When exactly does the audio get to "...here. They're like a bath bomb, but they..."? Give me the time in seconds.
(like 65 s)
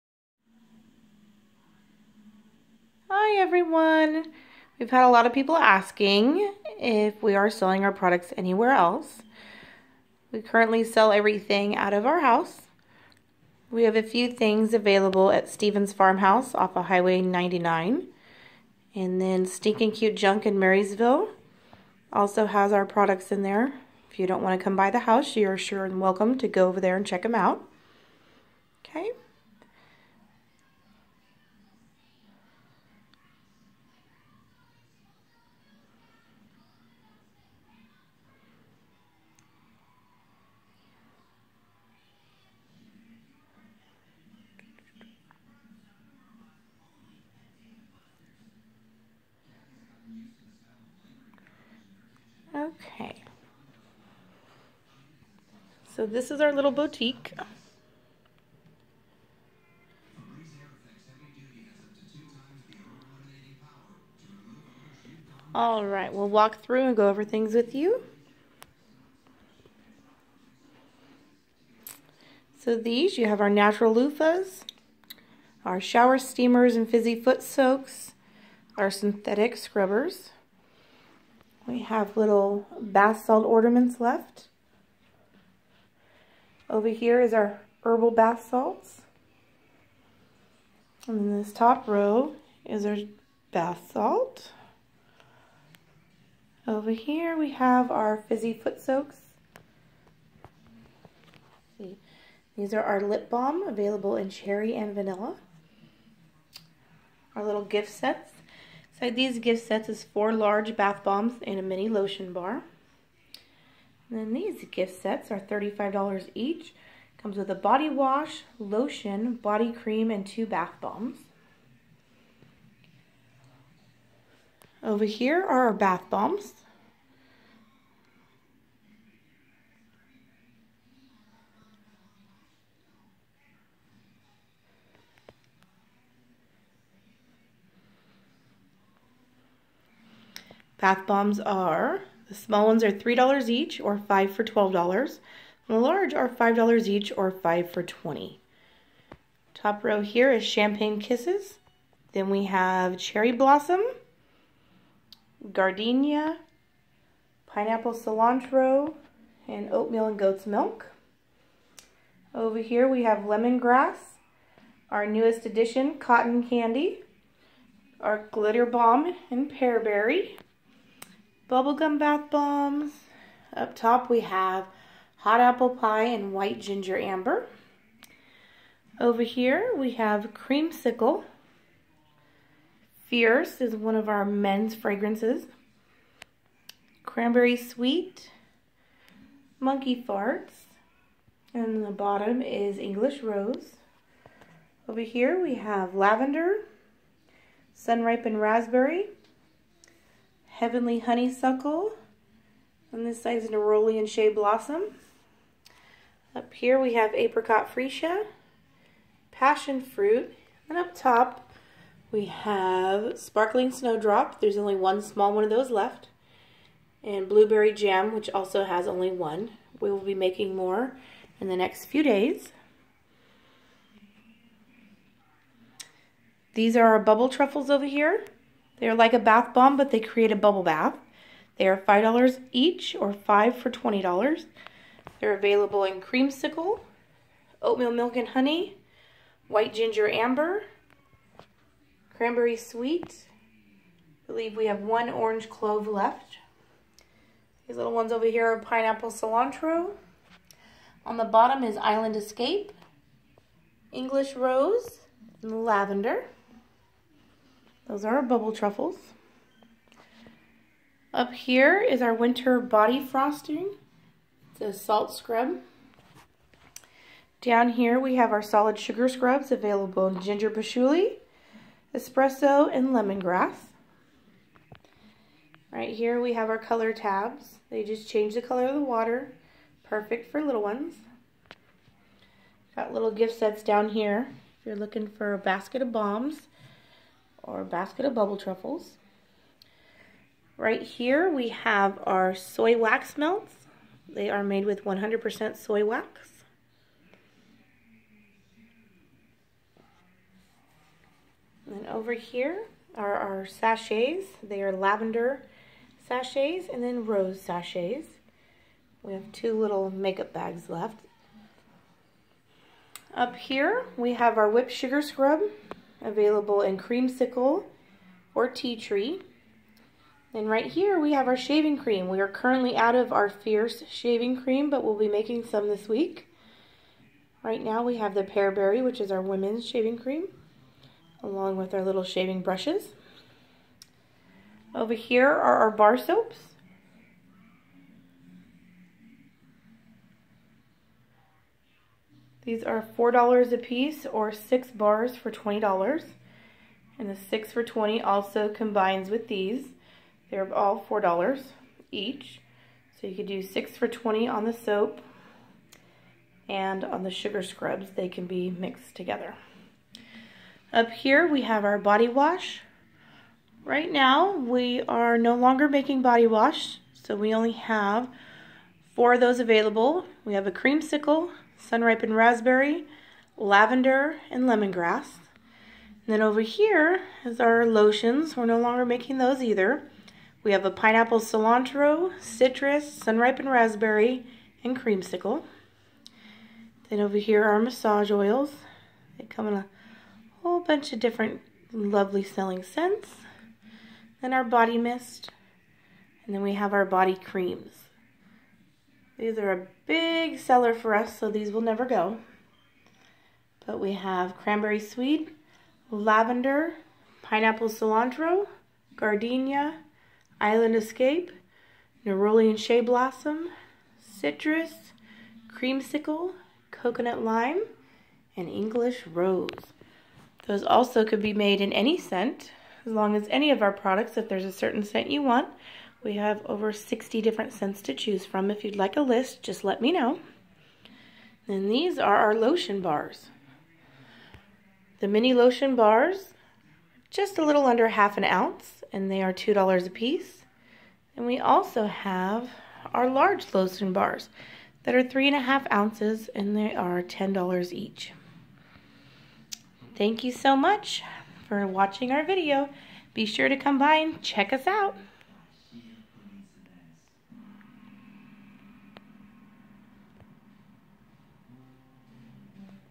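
227 s.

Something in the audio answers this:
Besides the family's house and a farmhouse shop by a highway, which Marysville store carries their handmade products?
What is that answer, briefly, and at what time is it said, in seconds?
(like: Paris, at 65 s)
Stinking Cute Junk, at 19 s.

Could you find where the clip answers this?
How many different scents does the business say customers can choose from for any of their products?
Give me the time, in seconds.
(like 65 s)
426 s.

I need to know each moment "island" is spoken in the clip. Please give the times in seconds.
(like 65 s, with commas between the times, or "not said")
251 s, 410 s.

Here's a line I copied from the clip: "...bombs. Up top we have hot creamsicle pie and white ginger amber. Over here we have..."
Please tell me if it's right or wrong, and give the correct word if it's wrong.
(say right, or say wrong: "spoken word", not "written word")
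wrong: "apple", not "creamsicle".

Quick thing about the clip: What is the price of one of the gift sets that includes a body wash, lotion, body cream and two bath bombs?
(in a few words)
$35.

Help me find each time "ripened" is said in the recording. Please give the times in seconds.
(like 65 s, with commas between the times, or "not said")
198 s, 371 s, 383 s.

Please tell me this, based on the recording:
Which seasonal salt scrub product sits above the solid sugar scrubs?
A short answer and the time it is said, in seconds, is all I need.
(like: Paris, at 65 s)
Winter body frosting, at 262 s.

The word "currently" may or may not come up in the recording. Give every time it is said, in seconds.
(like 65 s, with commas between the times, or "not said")
10 s, 322 s.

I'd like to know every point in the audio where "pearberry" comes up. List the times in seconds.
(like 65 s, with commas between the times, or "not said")
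169 s, 328 s.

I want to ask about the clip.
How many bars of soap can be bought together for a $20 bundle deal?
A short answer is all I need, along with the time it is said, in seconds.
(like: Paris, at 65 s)
6, at 344 s.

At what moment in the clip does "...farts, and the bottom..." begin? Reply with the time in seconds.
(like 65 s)
190 s.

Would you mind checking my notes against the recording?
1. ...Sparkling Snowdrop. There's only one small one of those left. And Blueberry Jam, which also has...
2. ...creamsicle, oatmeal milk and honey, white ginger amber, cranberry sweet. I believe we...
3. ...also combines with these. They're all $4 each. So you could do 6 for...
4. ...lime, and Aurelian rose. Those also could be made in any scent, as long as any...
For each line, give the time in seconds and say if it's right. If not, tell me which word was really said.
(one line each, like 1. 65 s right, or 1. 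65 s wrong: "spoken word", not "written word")
1. 213 s right
2. 236 s right
3. 348 s right
4. 417 s wrong: "English", not "Aurelian".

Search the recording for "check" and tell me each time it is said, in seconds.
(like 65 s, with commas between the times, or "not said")
27 s, 454 s.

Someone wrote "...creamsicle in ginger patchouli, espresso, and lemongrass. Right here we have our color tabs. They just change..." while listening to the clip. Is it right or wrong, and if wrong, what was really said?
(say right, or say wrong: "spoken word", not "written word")
wrong: "available", not "creamsicle".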